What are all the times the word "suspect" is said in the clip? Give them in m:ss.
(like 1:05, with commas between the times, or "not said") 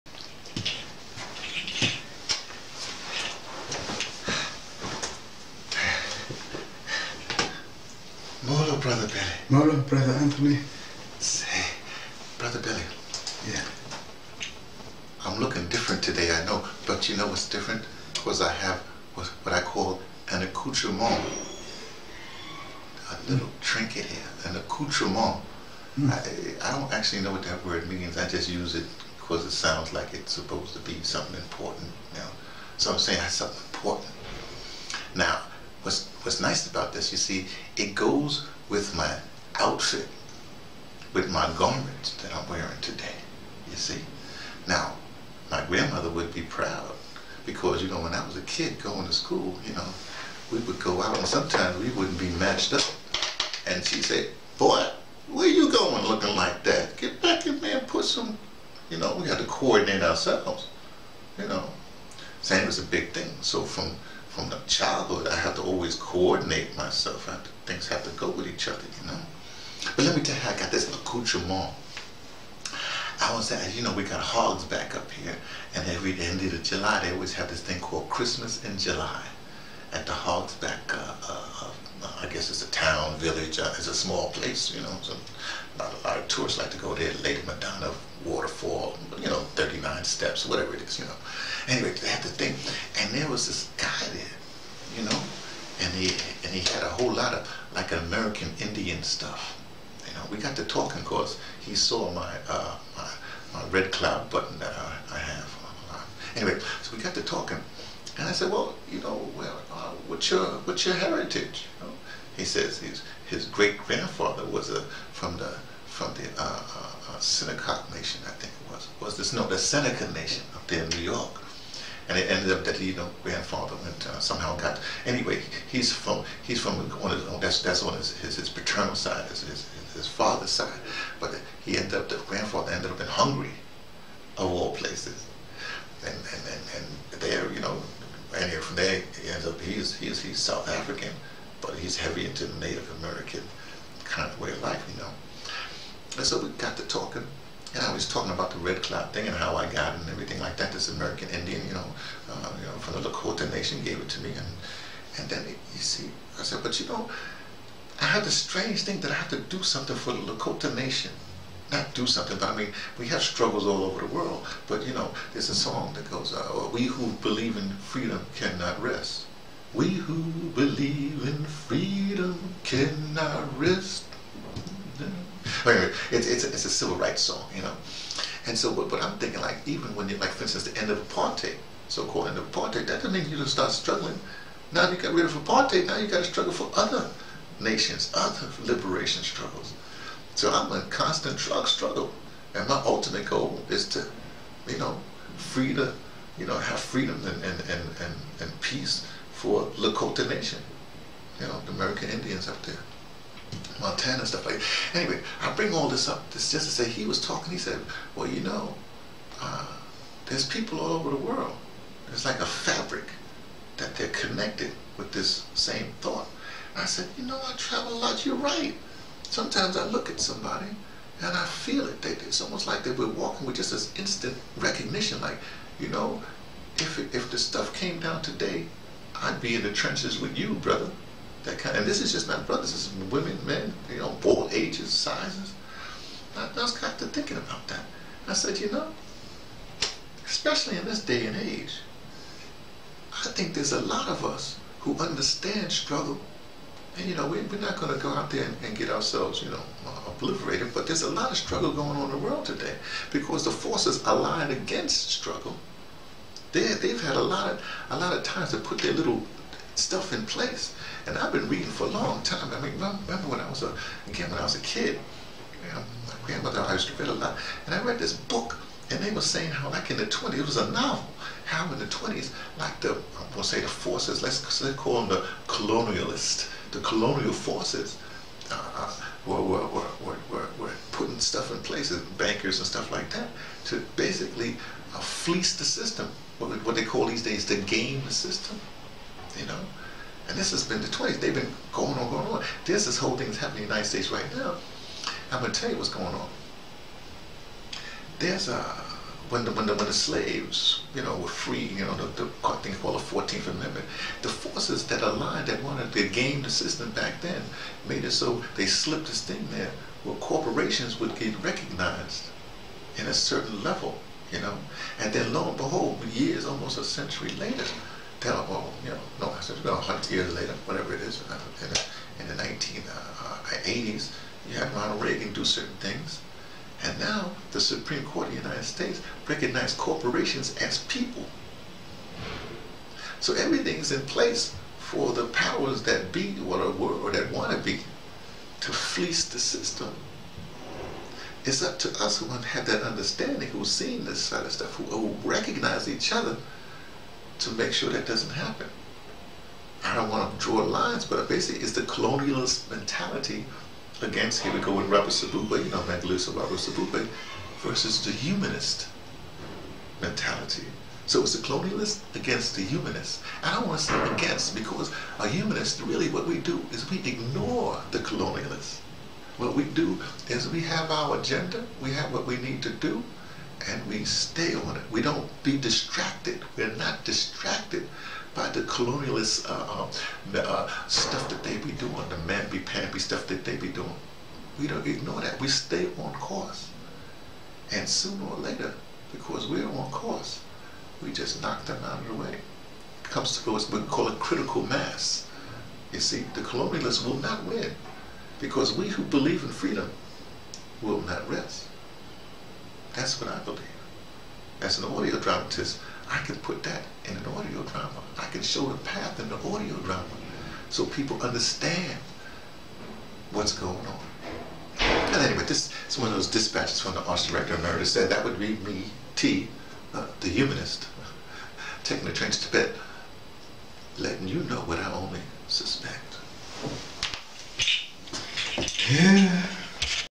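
7:05.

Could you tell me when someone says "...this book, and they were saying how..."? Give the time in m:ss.
4:27.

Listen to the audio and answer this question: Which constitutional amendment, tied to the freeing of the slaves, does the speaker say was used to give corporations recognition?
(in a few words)
14th Amendment.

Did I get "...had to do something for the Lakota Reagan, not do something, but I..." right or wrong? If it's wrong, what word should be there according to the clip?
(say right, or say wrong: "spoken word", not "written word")
wrong: "Nation", not "Reagan".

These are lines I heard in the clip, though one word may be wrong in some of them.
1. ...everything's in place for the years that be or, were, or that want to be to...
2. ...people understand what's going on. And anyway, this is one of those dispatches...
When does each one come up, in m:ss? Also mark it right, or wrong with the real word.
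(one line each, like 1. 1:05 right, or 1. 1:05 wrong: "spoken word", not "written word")
1. 5:33 wrong: "powers", not "years"
2. 6:50 right.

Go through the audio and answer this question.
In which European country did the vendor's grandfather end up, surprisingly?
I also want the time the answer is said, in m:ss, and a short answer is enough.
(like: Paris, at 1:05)
Hungary, at 2:13.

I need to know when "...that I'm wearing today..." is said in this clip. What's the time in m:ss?
0:42.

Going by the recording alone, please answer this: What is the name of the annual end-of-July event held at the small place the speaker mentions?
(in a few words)
Christmas in July.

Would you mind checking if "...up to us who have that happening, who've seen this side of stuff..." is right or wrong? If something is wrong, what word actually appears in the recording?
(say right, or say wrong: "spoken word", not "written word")
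wrong: "understanding", not "happening".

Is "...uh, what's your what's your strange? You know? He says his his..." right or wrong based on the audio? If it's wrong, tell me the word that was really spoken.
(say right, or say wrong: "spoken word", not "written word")
wrong: "heritage", not "strange".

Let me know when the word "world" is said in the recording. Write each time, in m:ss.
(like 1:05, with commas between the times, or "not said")
2:44, 3:31, 4:12.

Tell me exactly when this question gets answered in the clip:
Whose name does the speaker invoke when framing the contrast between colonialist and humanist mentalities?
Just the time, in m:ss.
5:55.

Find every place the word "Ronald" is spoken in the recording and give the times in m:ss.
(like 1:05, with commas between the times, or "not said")
5:24.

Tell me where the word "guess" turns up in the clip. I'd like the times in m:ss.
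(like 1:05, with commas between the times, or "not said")
1:22.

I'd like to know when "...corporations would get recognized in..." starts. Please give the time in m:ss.
5:10.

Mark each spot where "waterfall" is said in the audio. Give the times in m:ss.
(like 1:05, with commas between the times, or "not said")
1:28.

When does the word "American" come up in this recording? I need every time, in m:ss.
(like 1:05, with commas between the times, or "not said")
1:37, 2:22, 2:30, 3:21.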